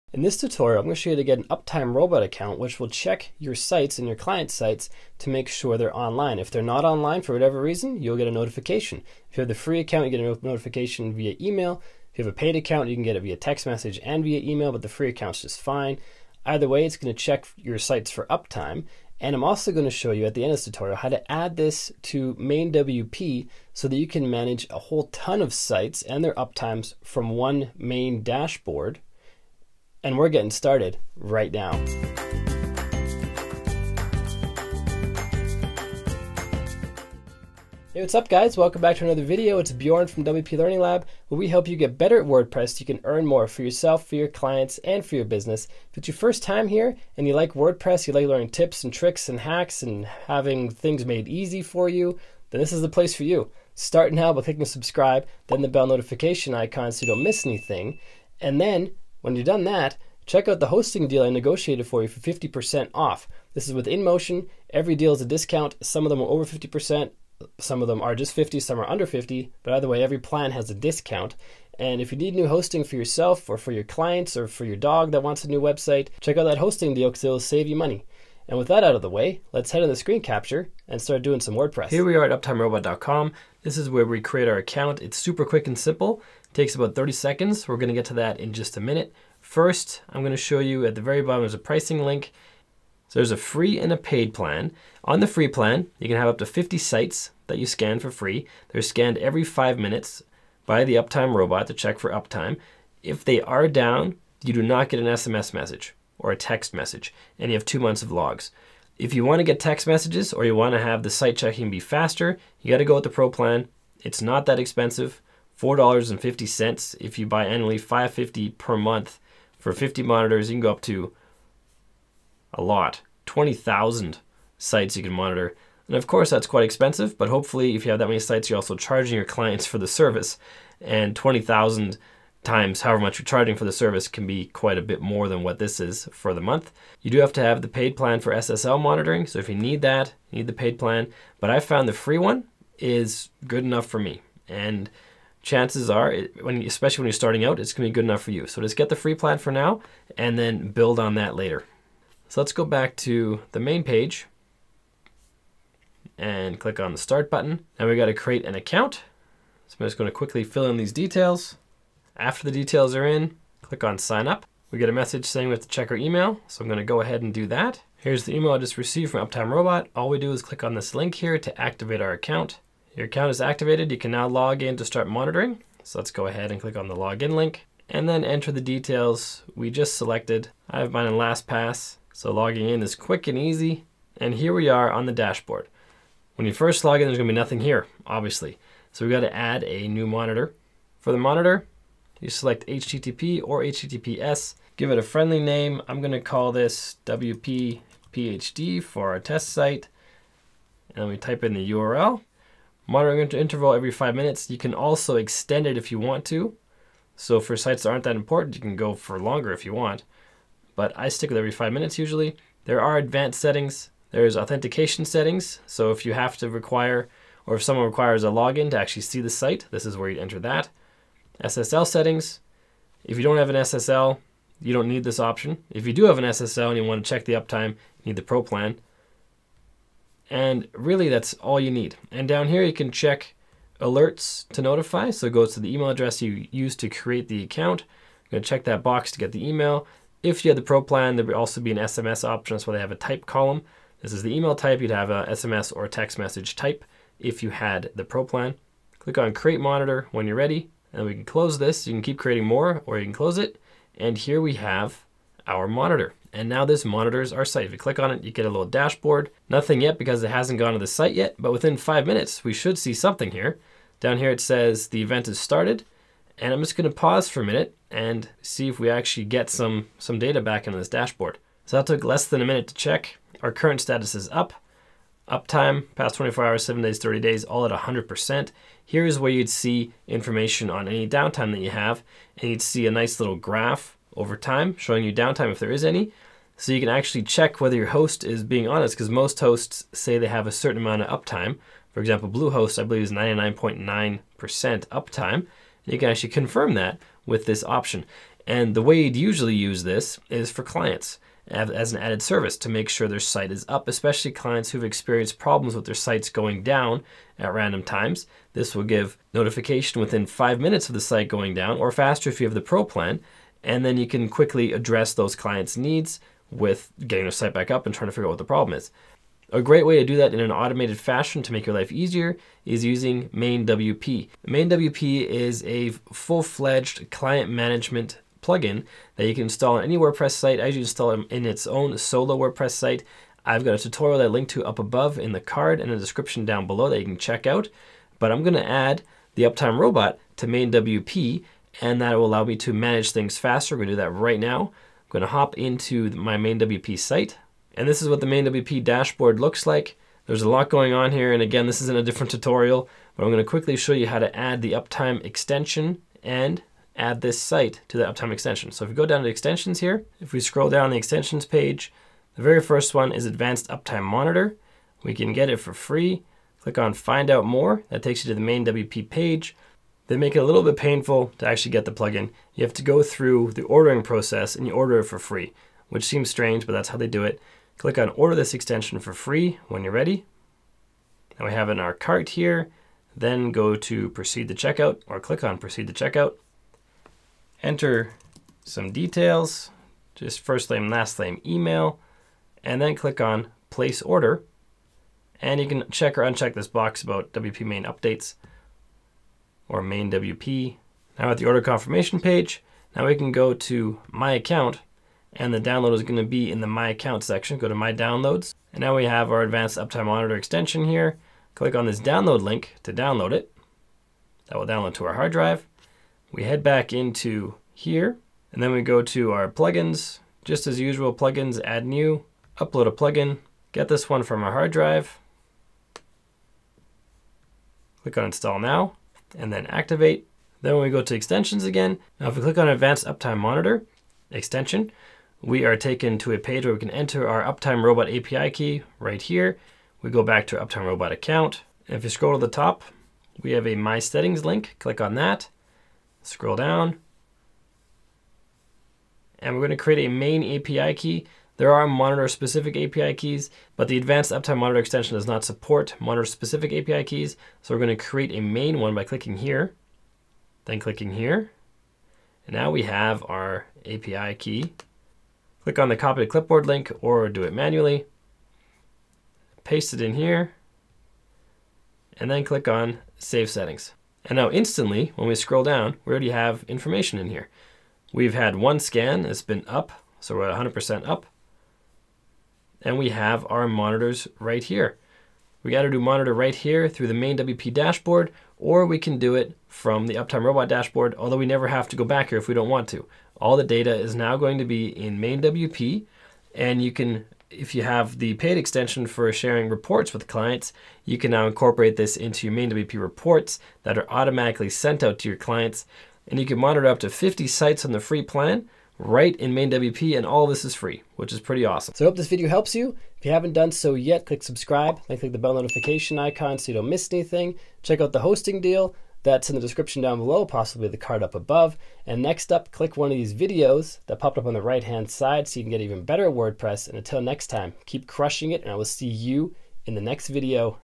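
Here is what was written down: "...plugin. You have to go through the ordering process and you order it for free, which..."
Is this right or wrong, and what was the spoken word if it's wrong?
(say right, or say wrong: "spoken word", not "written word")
right.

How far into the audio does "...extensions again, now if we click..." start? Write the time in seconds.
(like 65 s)
431 s.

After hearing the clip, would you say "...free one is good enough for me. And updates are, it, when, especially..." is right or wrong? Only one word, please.
wrong.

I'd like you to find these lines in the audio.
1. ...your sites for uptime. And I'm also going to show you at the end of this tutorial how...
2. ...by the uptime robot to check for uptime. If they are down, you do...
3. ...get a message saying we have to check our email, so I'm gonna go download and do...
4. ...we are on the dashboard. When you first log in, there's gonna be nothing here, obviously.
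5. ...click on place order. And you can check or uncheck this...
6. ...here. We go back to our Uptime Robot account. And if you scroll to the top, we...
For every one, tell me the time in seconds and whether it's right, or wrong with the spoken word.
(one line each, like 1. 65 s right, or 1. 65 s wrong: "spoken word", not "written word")
1. 17 s right
2. 100 s right
3. 164 s wrong: "ahead", not "download"
4. 184 s right
5. 392 s right
6. 439 s right.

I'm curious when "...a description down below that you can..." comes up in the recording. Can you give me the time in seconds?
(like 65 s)
335 s.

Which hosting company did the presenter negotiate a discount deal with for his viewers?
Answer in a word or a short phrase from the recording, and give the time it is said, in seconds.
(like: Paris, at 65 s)
InMotion, at 63 s.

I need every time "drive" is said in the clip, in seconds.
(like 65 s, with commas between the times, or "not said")
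415 s, 424 s.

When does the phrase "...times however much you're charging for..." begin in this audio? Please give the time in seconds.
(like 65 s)
132 s.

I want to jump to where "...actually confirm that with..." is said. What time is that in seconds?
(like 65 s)
296 s.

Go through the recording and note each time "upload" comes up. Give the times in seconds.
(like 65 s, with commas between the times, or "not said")
422 s.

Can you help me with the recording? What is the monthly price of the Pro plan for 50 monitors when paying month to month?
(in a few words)
$5.50.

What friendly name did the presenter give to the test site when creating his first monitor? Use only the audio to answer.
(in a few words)
WPPHD.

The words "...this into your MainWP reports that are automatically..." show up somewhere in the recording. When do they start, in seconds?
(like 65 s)
501 s.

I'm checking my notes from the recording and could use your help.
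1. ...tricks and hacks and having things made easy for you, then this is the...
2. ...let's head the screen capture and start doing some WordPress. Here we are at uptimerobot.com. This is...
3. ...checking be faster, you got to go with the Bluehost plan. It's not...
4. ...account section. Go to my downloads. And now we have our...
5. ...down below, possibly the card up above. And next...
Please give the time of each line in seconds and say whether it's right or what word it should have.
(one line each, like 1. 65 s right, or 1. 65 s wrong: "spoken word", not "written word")
1. 48 s right
2. 79 s right
3. 111 s wrong: "Pro", not "Bluehost"
4. 406 s right
5. 520 s right.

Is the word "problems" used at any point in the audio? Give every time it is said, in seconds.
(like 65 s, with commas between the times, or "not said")
305 s, 318 s.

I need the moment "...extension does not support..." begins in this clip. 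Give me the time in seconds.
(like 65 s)
454 s.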